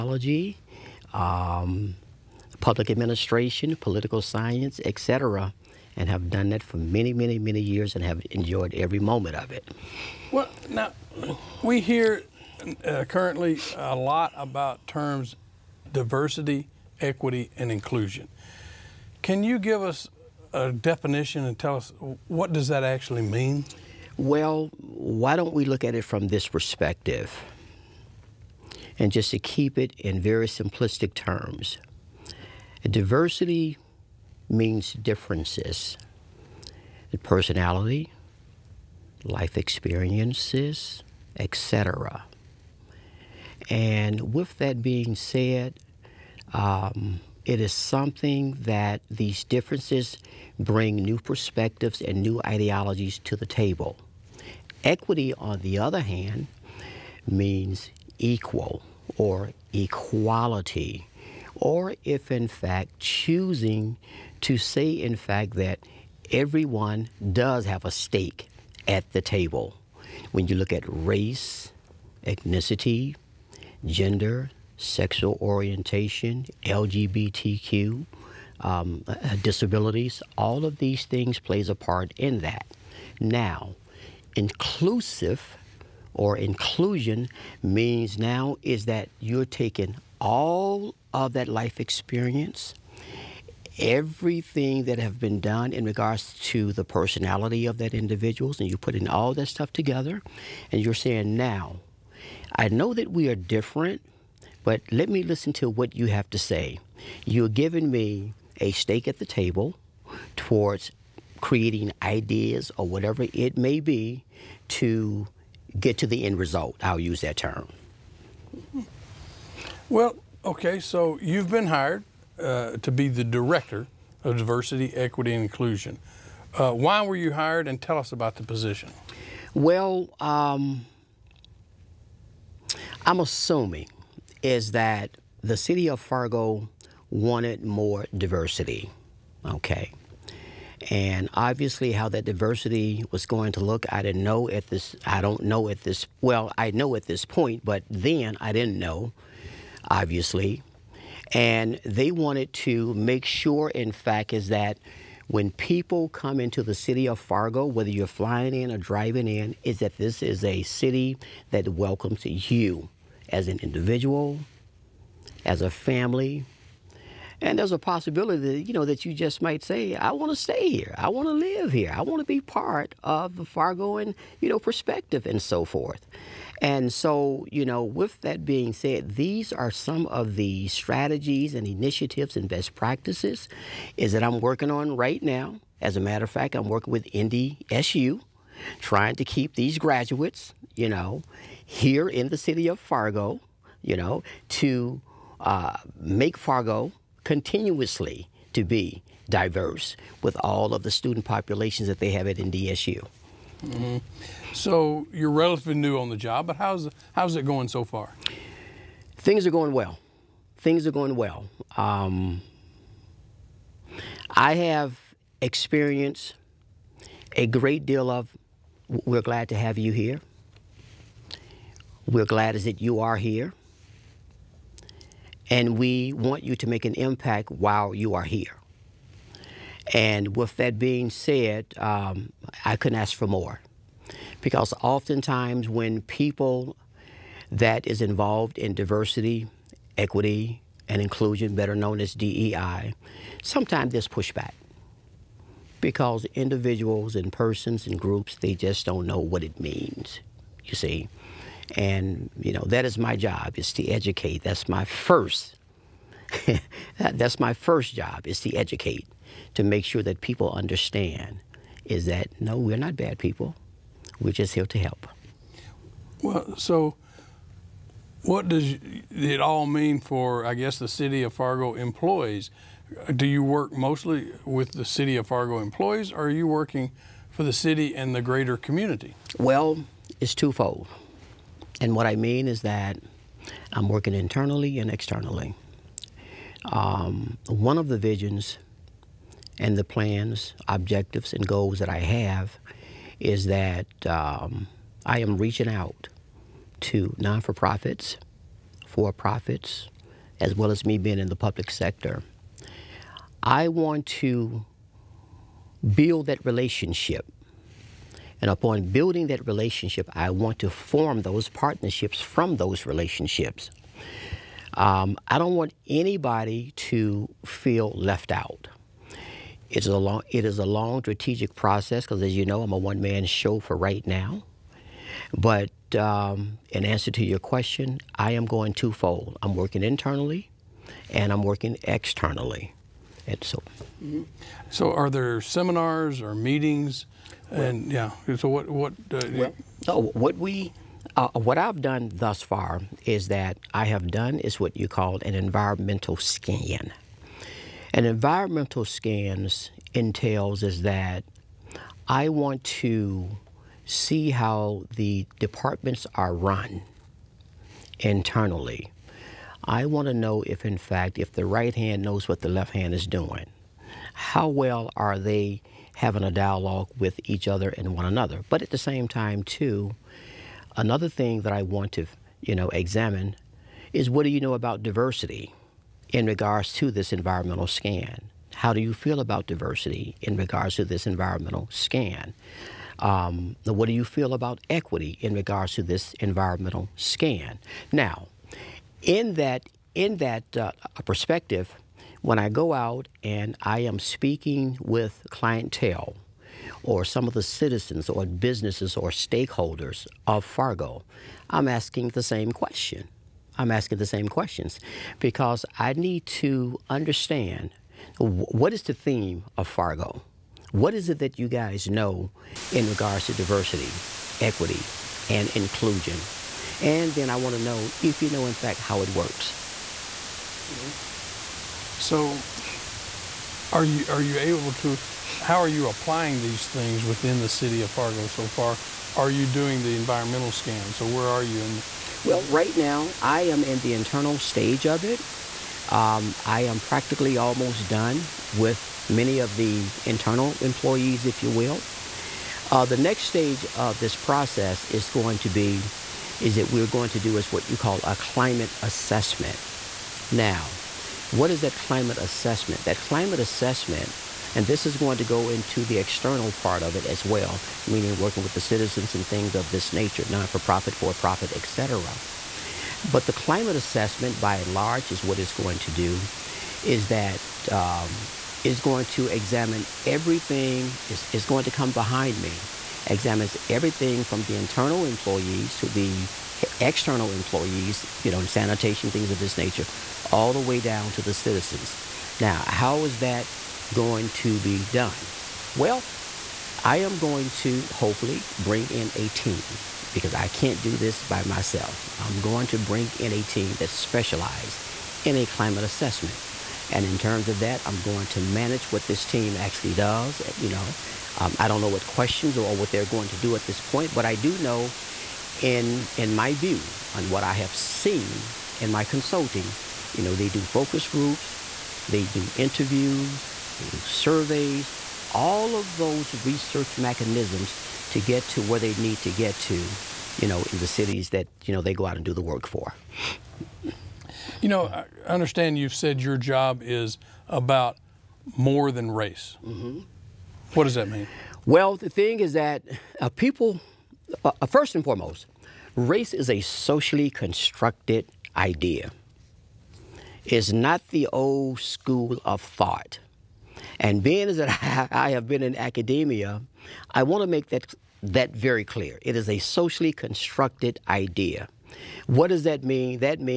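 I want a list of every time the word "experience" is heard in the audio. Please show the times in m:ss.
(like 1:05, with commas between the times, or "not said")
0:39, 1:31, 3:35.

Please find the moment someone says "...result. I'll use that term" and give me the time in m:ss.
1:56.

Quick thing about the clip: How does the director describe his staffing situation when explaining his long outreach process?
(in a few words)
a one man show.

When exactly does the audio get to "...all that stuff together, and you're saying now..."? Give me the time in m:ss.
1:39.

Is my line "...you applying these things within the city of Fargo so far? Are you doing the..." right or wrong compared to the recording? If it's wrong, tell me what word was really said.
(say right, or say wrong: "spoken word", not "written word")
right.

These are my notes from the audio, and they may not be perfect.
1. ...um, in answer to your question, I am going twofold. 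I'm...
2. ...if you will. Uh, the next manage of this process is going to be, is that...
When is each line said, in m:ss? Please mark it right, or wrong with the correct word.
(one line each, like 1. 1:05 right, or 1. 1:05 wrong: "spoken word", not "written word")
1. 5:25 right
2. 7:21 wrong: "stage", not "manage".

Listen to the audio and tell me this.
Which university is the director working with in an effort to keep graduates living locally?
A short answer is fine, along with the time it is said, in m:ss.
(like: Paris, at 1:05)
NDSU, at 3:22.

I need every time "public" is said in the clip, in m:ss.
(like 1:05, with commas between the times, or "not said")
0:02, 5:01.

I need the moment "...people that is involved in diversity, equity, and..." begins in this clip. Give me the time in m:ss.
3:56.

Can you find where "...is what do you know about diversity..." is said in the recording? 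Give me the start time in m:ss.
6:13.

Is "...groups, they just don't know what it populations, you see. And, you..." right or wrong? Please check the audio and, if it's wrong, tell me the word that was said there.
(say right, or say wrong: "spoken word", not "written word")
wrong: "means", not "populations".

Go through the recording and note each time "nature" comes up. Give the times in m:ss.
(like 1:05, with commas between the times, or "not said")
7:39, 7:59.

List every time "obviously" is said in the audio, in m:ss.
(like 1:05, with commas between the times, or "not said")
2:21, 2:29.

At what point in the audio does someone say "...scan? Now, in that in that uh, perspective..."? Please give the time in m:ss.
6:26.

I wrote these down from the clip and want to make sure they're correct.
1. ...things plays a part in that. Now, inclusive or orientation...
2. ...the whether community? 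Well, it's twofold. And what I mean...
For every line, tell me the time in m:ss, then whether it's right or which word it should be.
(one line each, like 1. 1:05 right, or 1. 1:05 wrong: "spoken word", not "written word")
1. 1:21 wrong: "inclusion", not "orientation"
2. 4:38 wrong: "greater", not "whether".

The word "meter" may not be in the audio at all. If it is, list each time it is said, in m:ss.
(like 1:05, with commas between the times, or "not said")
not said.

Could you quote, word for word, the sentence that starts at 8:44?
You know, I understand you've said your job is about more than race.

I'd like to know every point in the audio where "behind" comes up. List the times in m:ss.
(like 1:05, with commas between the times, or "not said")
7:51.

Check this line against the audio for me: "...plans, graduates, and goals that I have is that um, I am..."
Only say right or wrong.
wrong.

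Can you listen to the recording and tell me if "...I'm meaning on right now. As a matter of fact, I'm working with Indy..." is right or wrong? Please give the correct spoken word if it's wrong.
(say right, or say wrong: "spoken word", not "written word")
wrong: "working", not "meaning".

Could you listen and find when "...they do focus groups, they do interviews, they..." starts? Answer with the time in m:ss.
8:30.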